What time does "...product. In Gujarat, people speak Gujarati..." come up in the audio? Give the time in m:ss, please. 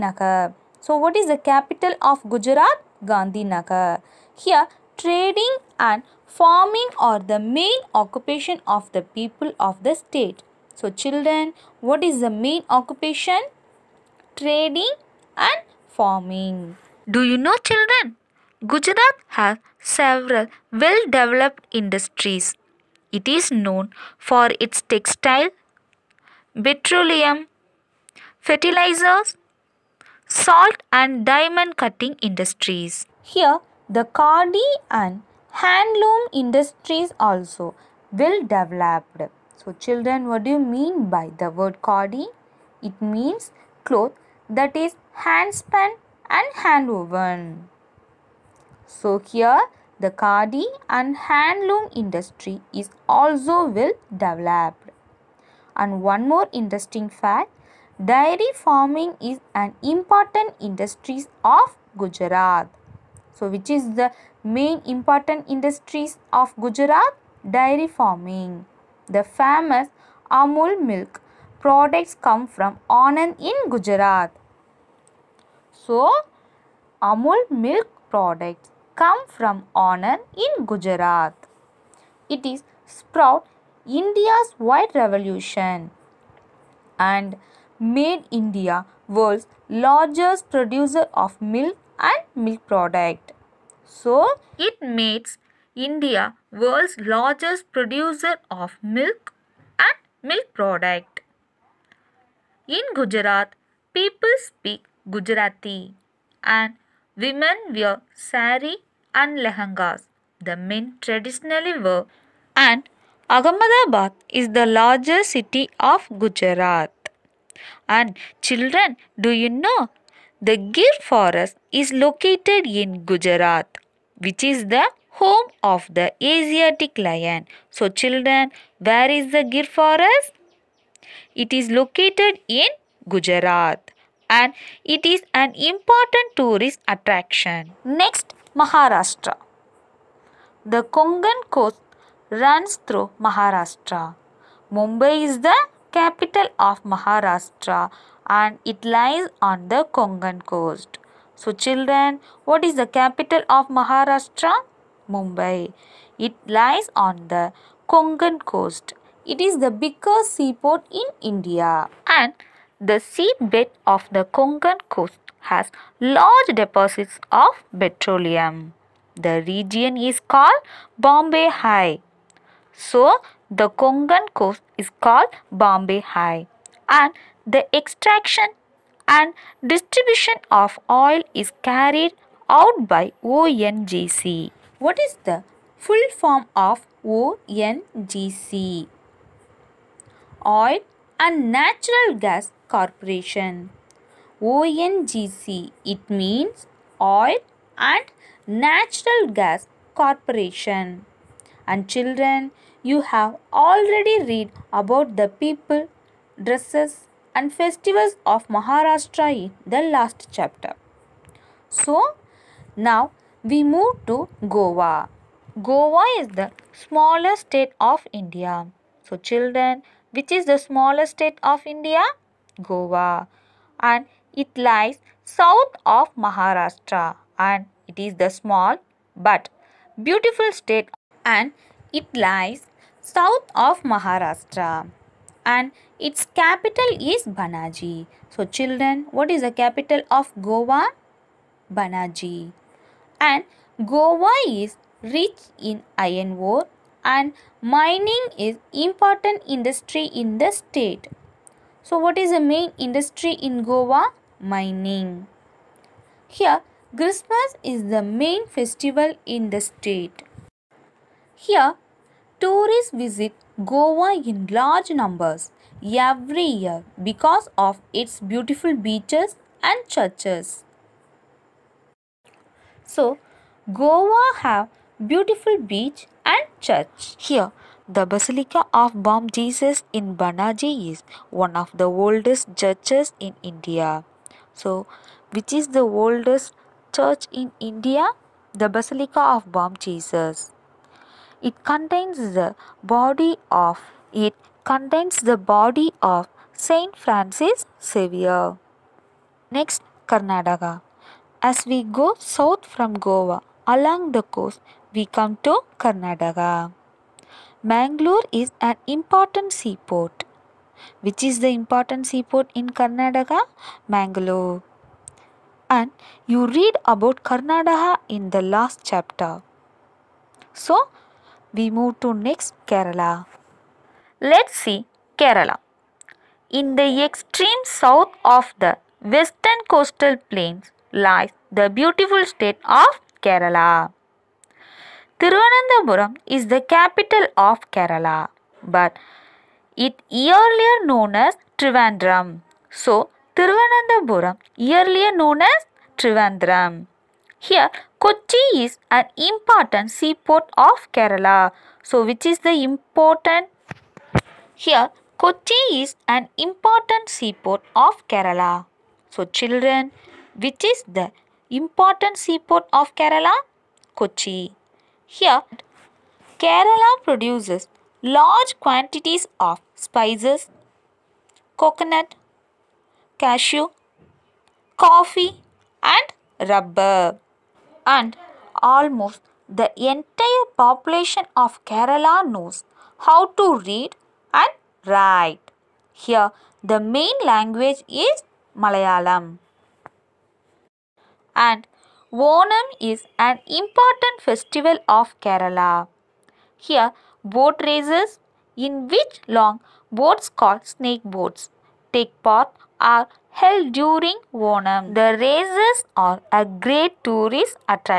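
1:40.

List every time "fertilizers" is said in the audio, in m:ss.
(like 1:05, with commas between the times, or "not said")
0:28.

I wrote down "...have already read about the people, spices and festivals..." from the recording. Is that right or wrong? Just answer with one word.
wrong.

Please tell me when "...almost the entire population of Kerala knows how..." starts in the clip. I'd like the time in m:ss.
6:18.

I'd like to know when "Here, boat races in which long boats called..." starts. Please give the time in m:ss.
6:36.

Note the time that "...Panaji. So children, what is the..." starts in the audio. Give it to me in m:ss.
3:57.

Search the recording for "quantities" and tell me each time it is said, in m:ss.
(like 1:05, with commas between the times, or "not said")
6:08.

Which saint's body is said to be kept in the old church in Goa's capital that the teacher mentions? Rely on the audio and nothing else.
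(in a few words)
Saint Francis Xavier.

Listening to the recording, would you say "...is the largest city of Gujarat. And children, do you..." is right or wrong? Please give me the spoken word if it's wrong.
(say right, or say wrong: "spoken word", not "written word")
right.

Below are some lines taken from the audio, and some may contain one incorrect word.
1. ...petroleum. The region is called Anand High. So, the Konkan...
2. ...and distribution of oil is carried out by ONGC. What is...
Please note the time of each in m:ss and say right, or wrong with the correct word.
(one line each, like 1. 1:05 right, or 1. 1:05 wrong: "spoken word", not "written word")
1. 2:47 wrong: "Bombay", not "Anand"
2. 2:59 right.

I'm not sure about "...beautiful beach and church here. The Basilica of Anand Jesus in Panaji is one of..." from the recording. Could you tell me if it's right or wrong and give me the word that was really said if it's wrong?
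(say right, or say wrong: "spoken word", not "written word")
wrong: "Bom", not "Anand".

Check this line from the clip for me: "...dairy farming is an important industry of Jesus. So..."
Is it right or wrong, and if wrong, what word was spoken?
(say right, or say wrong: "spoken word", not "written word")
wrong: "Gujarat", not "Jesus".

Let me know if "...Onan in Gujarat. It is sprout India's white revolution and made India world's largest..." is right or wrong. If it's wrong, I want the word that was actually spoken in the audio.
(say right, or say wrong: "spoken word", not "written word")
right.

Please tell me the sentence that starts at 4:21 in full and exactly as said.
Here tourists visit Goa in large numbers every year because of its beautiful beaches and churches.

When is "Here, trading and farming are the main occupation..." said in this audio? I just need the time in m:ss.
0:04.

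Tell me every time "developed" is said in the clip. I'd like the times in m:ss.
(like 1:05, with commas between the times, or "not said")
0:21, 0:38, 0:54.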